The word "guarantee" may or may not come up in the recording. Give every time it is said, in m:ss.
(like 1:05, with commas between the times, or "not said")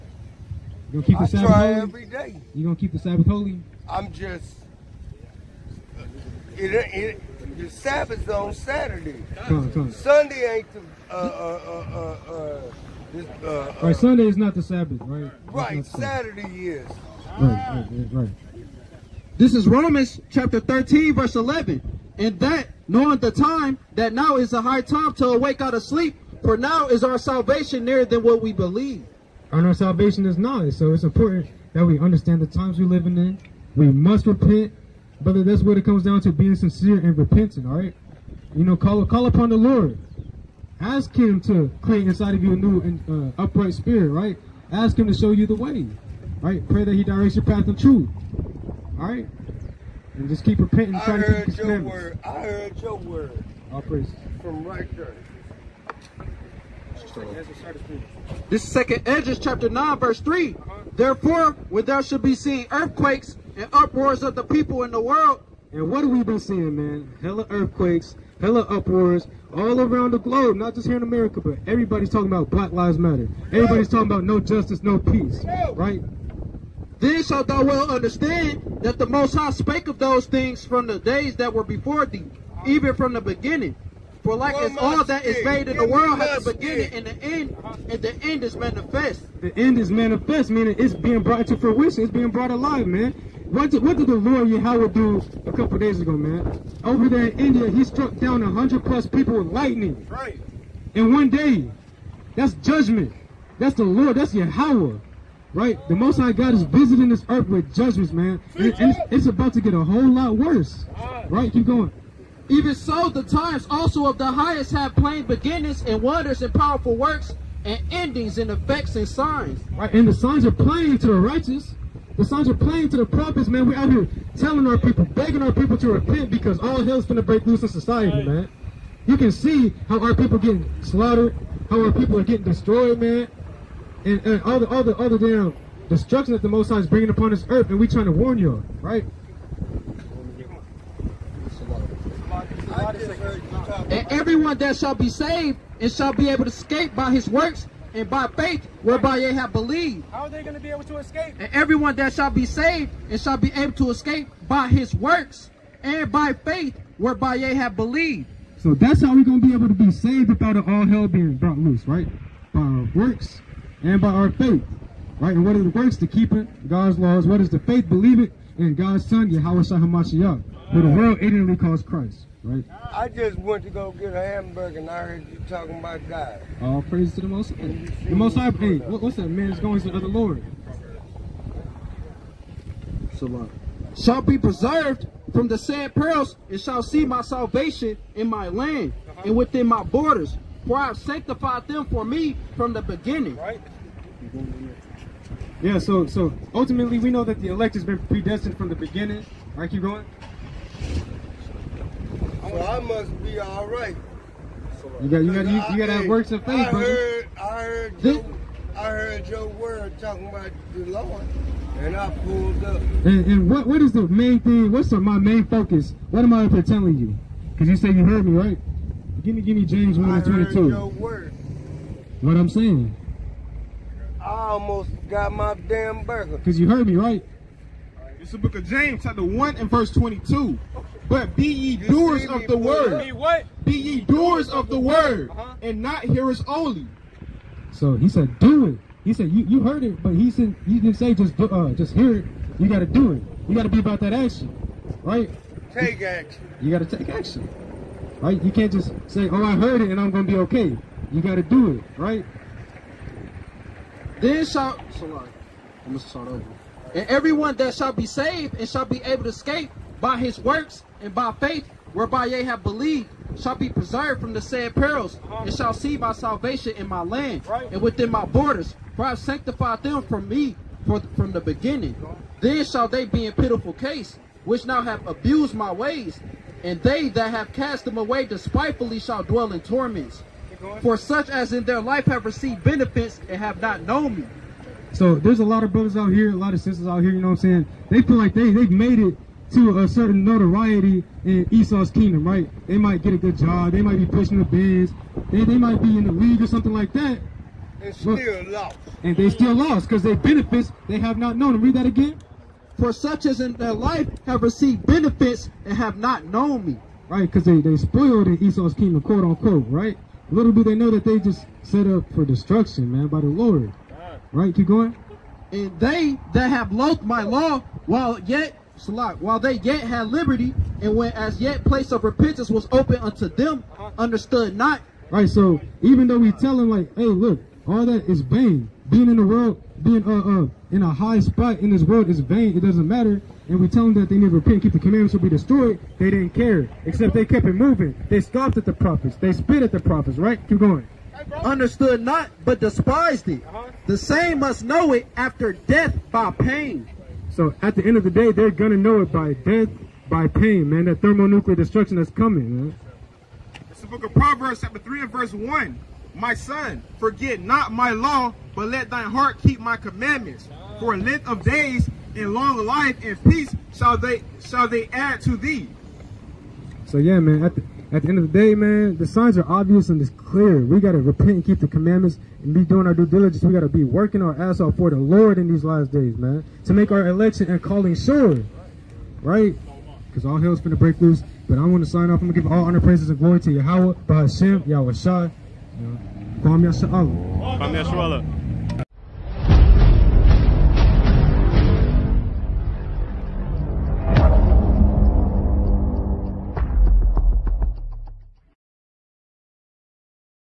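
not said.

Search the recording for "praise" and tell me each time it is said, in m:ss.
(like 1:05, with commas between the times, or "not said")
0:53, 2:56, 6:22.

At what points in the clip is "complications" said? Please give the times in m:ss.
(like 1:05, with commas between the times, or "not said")
not said.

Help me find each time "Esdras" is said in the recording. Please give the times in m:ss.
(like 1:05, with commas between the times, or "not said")
0:59.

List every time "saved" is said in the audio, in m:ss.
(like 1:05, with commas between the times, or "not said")
2:25, 2:32, 2:39, 4:18.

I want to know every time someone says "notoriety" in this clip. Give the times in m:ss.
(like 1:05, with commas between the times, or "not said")
4:50.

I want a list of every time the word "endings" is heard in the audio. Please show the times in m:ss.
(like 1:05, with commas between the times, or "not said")
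1:57.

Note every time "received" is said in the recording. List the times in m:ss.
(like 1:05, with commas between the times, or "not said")
4:42, 5:04.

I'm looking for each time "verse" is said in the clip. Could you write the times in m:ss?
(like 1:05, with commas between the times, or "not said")
0:21, 0:59, 3:49, 5:55.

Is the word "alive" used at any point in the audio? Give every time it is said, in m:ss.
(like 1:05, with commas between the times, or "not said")
1:32.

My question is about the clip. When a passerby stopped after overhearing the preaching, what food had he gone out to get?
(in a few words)
A hamburger.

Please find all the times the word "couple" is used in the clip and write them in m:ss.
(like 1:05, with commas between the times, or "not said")
1:35.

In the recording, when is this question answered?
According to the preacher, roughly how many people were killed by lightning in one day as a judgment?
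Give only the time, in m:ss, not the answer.
1:38.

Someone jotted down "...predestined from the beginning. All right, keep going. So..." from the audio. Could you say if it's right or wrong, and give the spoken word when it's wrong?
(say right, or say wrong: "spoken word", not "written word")
right.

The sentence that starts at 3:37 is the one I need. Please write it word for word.
Because you say you heard me, right?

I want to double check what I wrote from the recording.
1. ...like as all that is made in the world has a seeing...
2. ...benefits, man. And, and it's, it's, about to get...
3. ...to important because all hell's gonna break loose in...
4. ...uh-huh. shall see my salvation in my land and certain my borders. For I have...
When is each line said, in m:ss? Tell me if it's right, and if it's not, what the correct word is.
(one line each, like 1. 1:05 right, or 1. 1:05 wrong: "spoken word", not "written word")
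1. 1:24 wrong: "beginning", not "seeing"
2. 1:47 wrong: "judgments", not "benefits"
3. 2:05 wrong: "repent", not "important"
4. 4:25 wrong: "within", not "certain".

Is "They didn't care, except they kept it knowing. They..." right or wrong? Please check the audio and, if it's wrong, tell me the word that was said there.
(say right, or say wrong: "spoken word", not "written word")
wrong: "moving", not "knowing".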